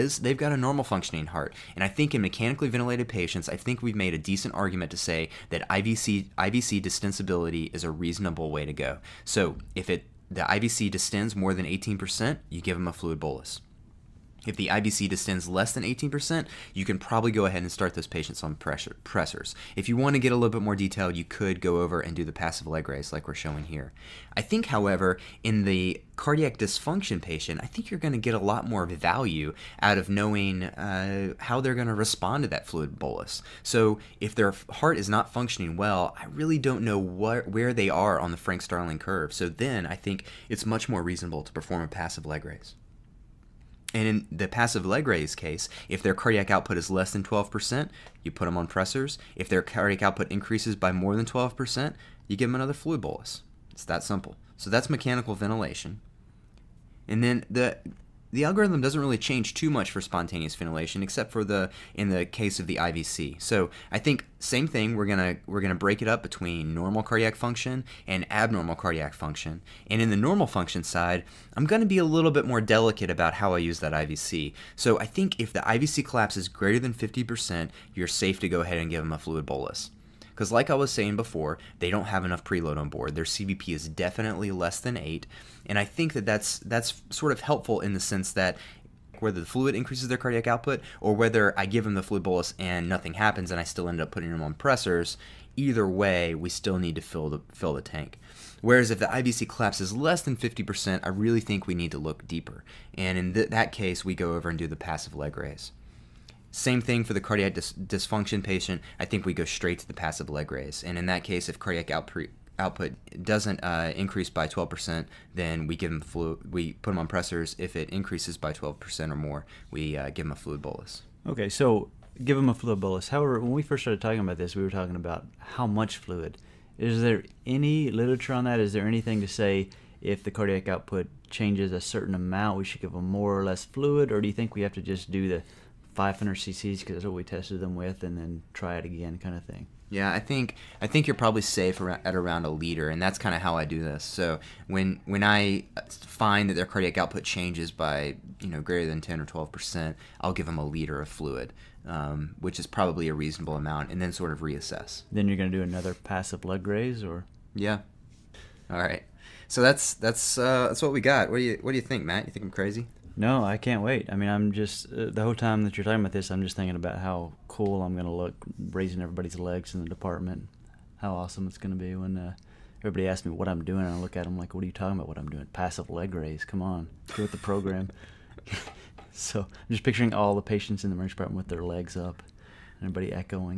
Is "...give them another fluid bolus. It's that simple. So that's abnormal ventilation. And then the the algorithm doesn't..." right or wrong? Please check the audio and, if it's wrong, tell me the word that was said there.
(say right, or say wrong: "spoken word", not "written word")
wrong: "mechanical", not "abnormal".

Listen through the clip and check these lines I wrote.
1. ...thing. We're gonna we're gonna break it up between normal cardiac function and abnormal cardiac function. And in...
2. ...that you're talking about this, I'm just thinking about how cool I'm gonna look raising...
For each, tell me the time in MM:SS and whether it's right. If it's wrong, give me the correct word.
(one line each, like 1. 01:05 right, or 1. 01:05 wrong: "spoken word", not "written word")
1. 01:04 right
2. 02:45 right.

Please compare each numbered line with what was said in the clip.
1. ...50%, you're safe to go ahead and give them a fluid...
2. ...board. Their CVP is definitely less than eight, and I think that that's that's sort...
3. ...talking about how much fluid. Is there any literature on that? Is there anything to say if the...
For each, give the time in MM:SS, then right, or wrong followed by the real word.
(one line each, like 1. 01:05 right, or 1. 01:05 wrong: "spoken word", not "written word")
1. 01:16 right
2. 01:22 right
3. 02:04 right.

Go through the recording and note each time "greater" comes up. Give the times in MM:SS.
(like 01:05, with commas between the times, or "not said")
01:16, 02:28.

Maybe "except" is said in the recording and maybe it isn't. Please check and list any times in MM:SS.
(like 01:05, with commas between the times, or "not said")
01:01.